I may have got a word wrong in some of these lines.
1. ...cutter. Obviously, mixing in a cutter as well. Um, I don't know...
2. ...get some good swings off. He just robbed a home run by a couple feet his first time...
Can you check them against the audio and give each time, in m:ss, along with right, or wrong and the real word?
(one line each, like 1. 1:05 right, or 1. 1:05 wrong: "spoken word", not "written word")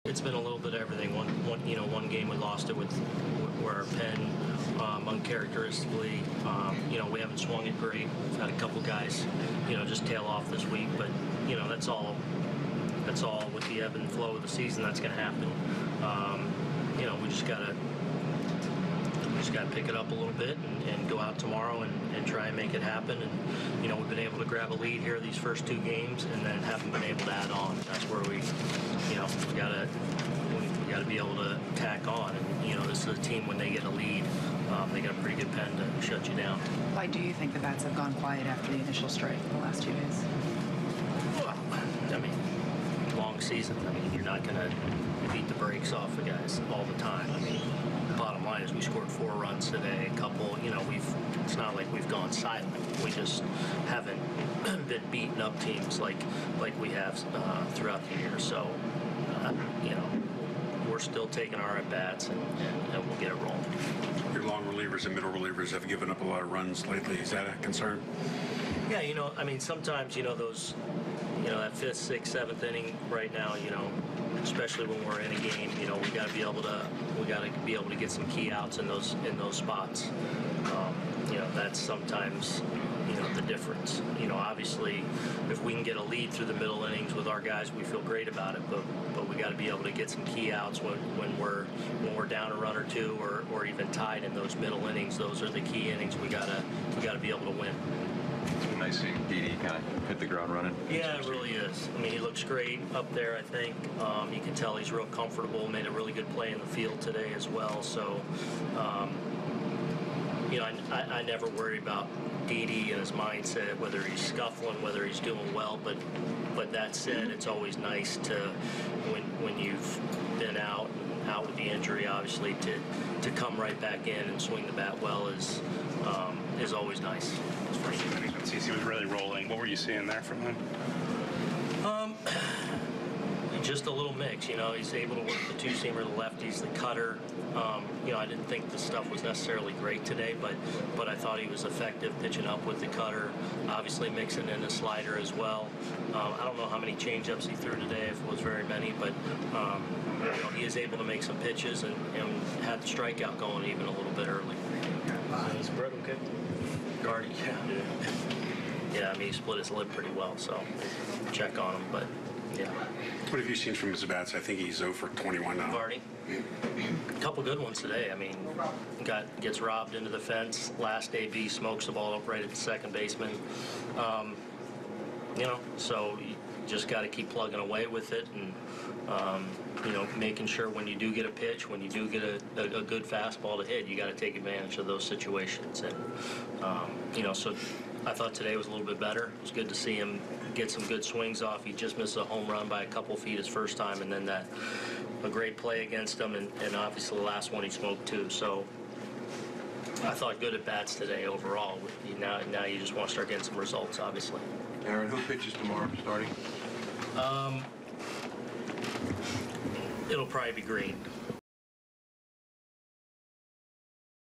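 1. 2:22 wrong: "slider", not "cutter"
2. 3:10 wrong: "missed", not "robbed".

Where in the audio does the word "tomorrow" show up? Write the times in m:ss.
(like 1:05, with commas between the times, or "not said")
0:21, 3:25.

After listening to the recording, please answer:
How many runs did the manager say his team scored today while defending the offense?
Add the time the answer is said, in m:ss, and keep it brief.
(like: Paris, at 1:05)
4, at 0:49.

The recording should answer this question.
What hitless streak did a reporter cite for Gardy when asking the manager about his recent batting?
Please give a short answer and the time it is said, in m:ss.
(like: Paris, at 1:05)
0 for 21, at 2:44.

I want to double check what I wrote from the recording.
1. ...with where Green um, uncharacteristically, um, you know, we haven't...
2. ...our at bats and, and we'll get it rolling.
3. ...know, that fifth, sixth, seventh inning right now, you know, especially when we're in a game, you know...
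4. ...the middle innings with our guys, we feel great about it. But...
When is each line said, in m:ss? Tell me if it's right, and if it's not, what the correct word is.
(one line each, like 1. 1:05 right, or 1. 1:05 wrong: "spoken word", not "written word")
1. 0:02 wrong: "Penn", not "Green"
2. 1:01 right
3. 1:11 right
4. 1:26 right.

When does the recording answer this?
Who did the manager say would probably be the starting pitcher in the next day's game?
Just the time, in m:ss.
3:30.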